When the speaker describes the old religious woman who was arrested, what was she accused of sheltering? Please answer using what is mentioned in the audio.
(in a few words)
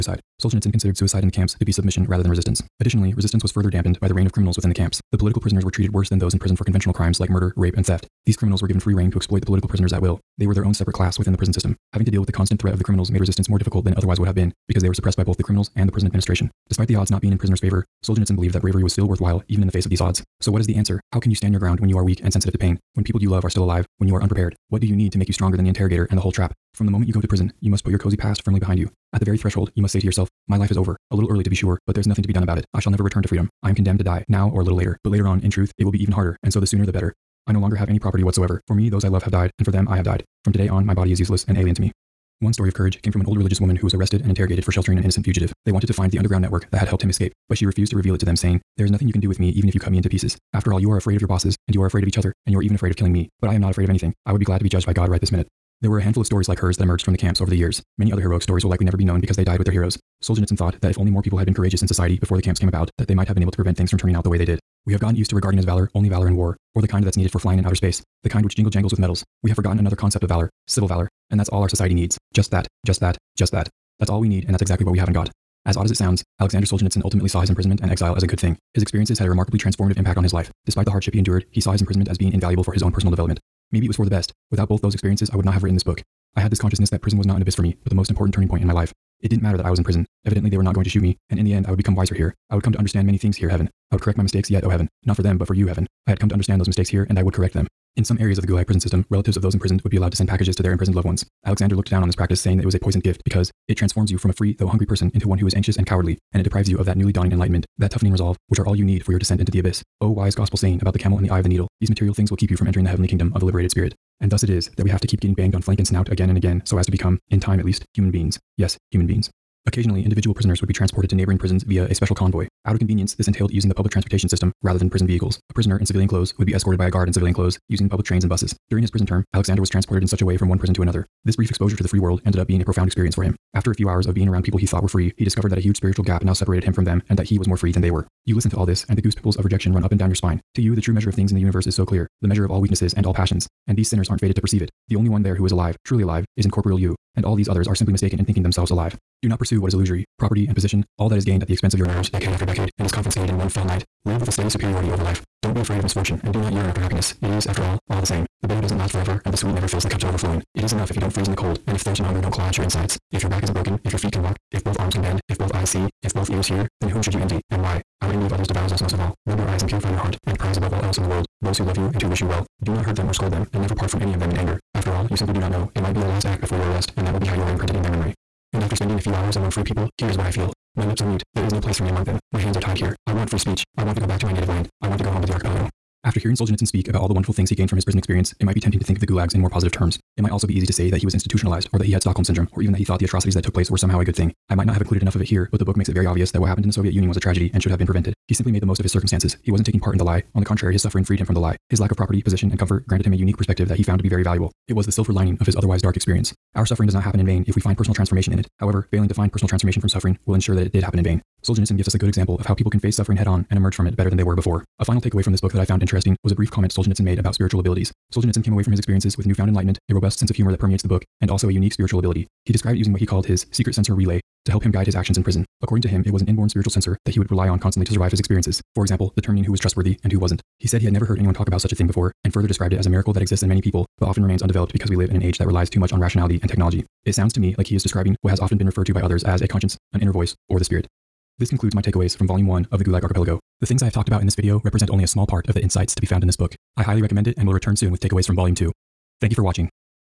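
an innocent fugitive.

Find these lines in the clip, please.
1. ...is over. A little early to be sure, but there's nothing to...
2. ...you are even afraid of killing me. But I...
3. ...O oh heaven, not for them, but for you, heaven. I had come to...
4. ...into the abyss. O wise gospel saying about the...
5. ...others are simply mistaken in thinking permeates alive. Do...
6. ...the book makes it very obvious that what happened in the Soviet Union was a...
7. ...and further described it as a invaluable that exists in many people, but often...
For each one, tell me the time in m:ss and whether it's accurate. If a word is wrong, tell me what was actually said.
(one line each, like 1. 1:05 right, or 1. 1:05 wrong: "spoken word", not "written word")
1. 0:30 right
2. 0:52 right
3. 1:34 right
4. 1:49 right
5. 2:27 wrong: "themselves", not "permeates"
6. 3:15 right
7. 3:52 wrong: "miracle", not "invaluable".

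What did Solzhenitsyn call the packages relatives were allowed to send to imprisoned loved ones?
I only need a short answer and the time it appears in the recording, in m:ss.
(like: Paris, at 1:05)
a poisoned gift, at 1:42.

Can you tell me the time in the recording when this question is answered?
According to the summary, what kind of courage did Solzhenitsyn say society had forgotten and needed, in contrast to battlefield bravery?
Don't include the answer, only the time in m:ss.
1:10.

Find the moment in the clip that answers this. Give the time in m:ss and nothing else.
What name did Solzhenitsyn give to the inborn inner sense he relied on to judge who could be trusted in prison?
3:43.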